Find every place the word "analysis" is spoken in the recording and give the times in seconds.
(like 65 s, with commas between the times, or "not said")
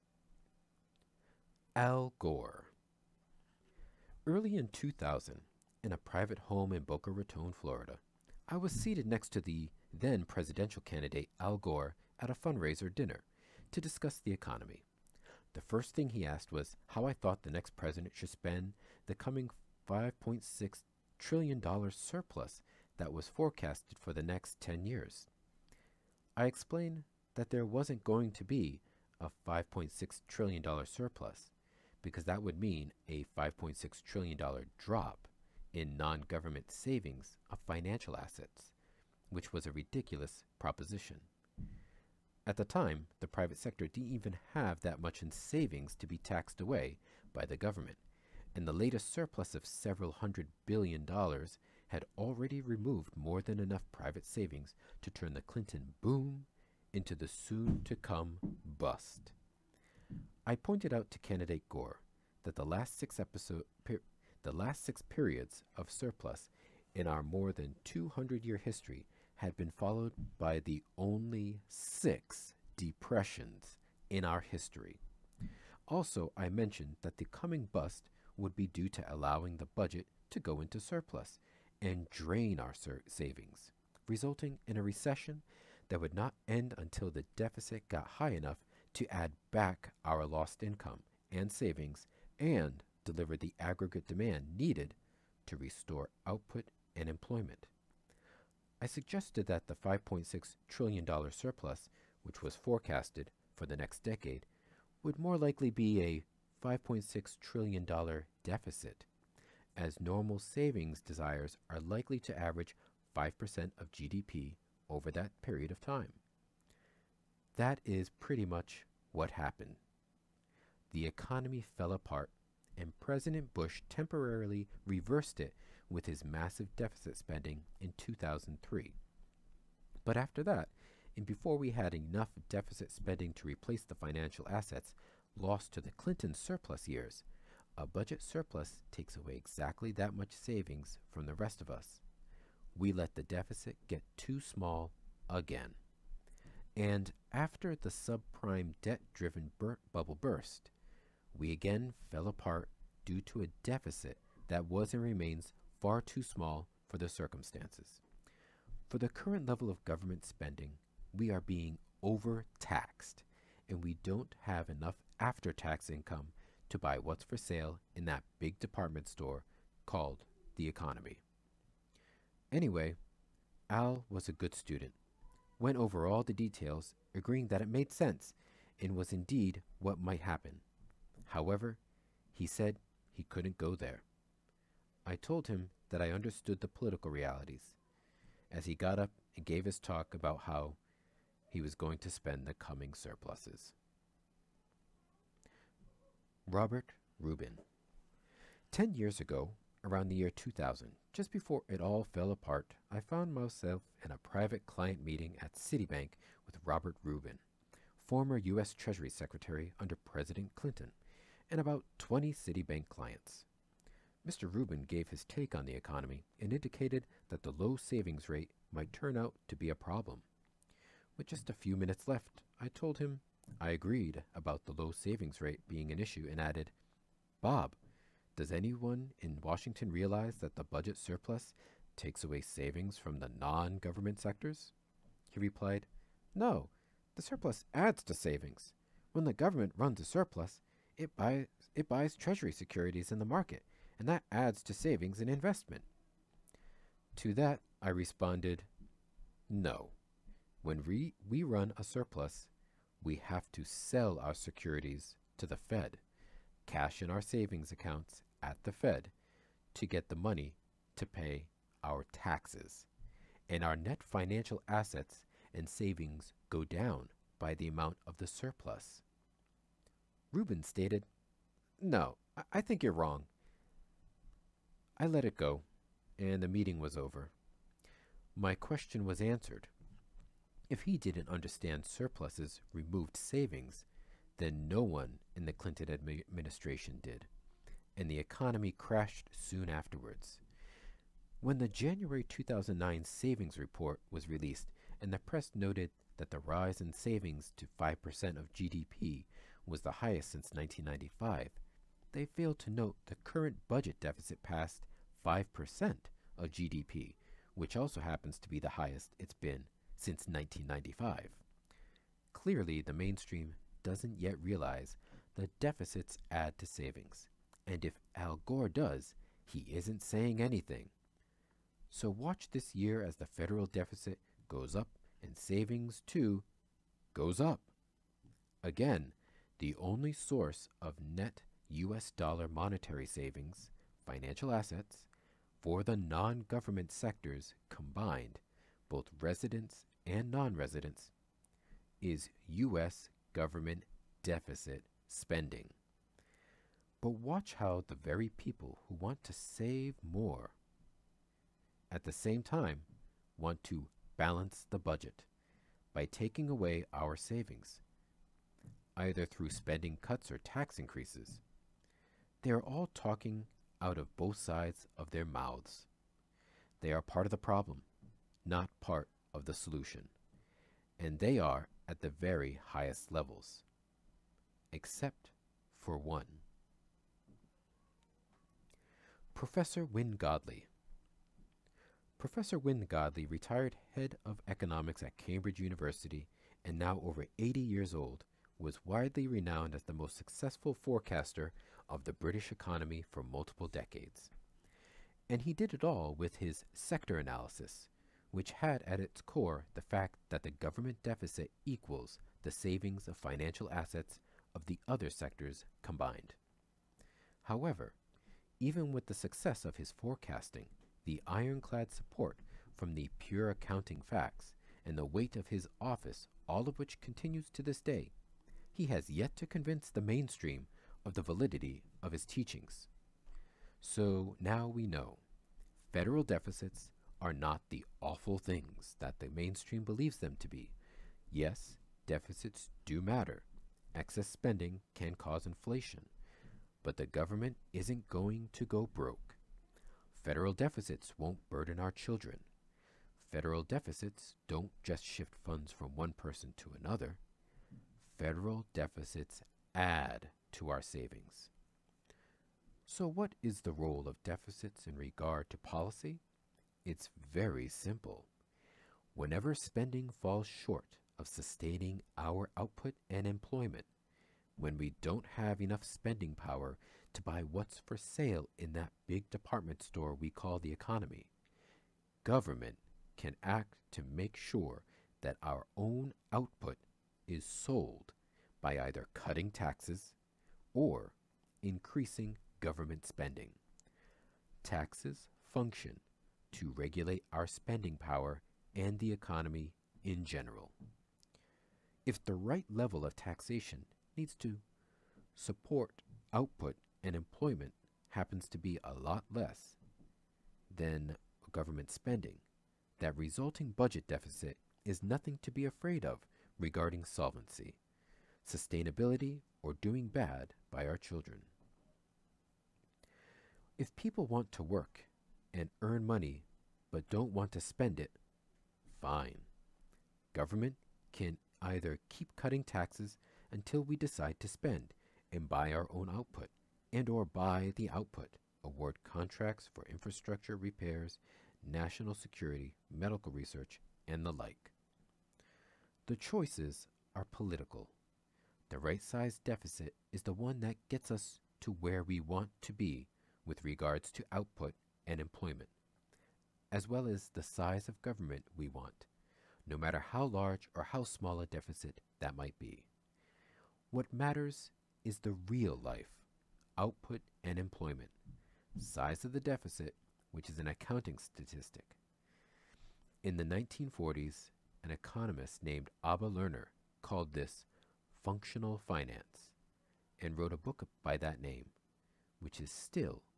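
397 s.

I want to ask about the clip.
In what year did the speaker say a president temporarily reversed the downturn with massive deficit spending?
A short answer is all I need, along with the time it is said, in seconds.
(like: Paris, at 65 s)
2003, at 127 s.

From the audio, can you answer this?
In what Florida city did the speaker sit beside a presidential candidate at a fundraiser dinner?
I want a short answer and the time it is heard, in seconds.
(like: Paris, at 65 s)
Boca Raton, at 6 s.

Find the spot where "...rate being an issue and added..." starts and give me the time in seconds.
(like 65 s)
225 s.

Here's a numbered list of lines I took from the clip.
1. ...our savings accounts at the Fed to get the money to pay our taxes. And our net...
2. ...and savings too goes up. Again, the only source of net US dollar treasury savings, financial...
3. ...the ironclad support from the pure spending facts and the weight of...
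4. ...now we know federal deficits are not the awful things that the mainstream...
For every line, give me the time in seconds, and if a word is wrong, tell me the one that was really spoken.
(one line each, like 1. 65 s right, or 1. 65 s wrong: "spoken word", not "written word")
1. 257 s right
2. 325 s wrong: "monetary", not "treasury"
3. 411 s wrong: "accounting", not "spending"
4. 424 s right.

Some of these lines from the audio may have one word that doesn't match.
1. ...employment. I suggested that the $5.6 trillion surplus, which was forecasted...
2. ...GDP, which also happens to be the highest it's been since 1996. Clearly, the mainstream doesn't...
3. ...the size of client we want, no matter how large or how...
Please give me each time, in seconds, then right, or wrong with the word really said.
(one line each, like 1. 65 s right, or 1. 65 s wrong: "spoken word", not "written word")
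1. 97 s right
2. 306 s wrong: "1995", not "1996"
3. 547 s wrong: "government", not "client".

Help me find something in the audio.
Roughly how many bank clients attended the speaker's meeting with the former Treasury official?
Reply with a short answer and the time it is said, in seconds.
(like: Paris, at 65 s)
20, at 211 s.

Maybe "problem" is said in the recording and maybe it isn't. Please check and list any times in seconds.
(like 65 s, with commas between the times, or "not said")
219 s, 367 s.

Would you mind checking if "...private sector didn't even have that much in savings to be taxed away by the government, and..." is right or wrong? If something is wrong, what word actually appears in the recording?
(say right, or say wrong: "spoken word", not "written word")
right.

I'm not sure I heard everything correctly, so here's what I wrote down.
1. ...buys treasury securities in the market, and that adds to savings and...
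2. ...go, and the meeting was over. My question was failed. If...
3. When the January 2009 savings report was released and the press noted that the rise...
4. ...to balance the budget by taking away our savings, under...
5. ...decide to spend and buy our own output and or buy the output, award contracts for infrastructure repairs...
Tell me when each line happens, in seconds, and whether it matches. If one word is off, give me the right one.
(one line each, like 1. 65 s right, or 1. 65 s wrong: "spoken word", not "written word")
1. 241 s right
2. 275 s wrong: "answered", not "failed"
3. 291 s right
4. 353 s wrong: "either", not "under"
5. 523 s right.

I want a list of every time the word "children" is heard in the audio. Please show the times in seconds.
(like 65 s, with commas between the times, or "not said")
441 s, 510 s.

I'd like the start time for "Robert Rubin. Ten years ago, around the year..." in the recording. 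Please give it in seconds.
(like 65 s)
196 s.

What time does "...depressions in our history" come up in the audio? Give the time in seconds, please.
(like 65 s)
72 s.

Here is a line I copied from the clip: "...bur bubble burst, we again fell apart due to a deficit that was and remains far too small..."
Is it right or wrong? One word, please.
right.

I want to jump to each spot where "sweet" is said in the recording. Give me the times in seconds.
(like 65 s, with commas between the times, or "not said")
not said.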